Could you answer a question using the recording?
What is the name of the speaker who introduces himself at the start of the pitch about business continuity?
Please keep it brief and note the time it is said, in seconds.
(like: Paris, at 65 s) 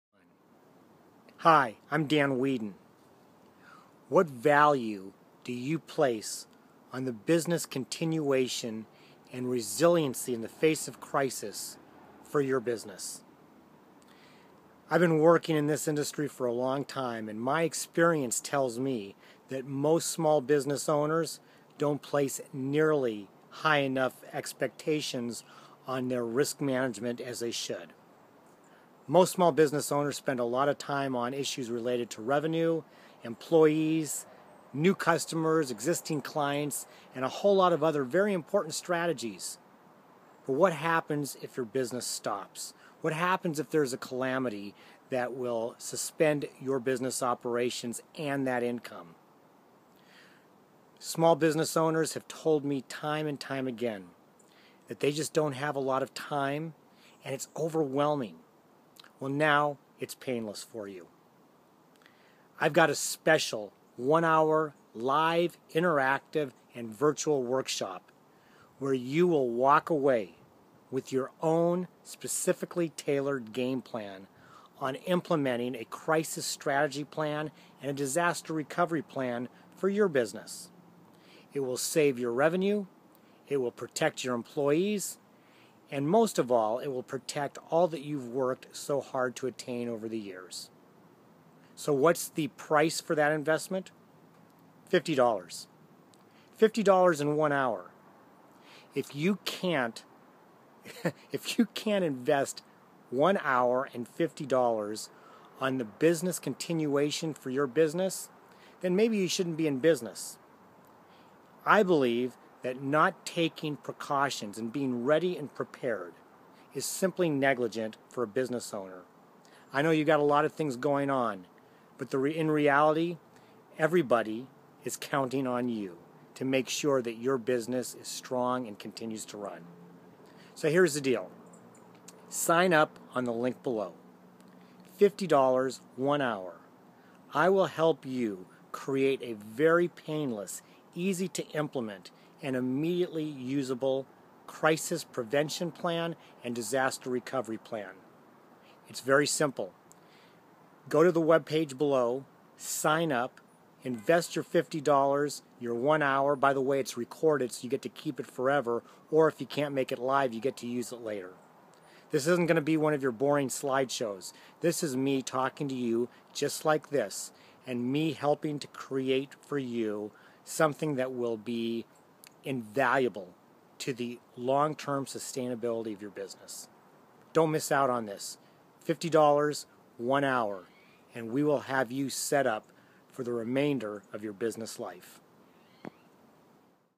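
Dan Weedin, at 2 s.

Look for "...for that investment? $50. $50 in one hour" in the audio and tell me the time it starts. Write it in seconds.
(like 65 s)
93 s.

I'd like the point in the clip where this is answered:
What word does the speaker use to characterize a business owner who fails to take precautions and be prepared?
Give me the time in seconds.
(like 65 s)
117 s.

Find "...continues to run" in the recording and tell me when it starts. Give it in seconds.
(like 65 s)
128 s.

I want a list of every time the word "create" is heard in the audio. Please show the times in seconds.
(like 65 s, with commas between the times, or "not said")
138 s, 168 s.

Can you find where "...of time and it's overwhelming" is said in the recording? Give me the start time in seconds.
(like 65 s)
56 s.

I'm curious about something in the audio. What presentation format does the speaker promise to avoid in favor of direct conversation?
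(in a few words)
boring slideshows.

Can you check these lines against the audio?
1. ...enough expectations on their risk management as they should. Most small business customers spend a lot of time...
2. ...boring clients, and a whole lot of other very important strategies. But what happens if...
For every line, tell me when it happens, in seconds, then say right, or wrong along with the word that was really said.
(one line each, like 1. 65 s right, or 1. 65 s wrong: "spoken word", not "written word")
1. 23 s wrong: "owners", not "customers"
2. 35 s wrong: "existing", not "boring".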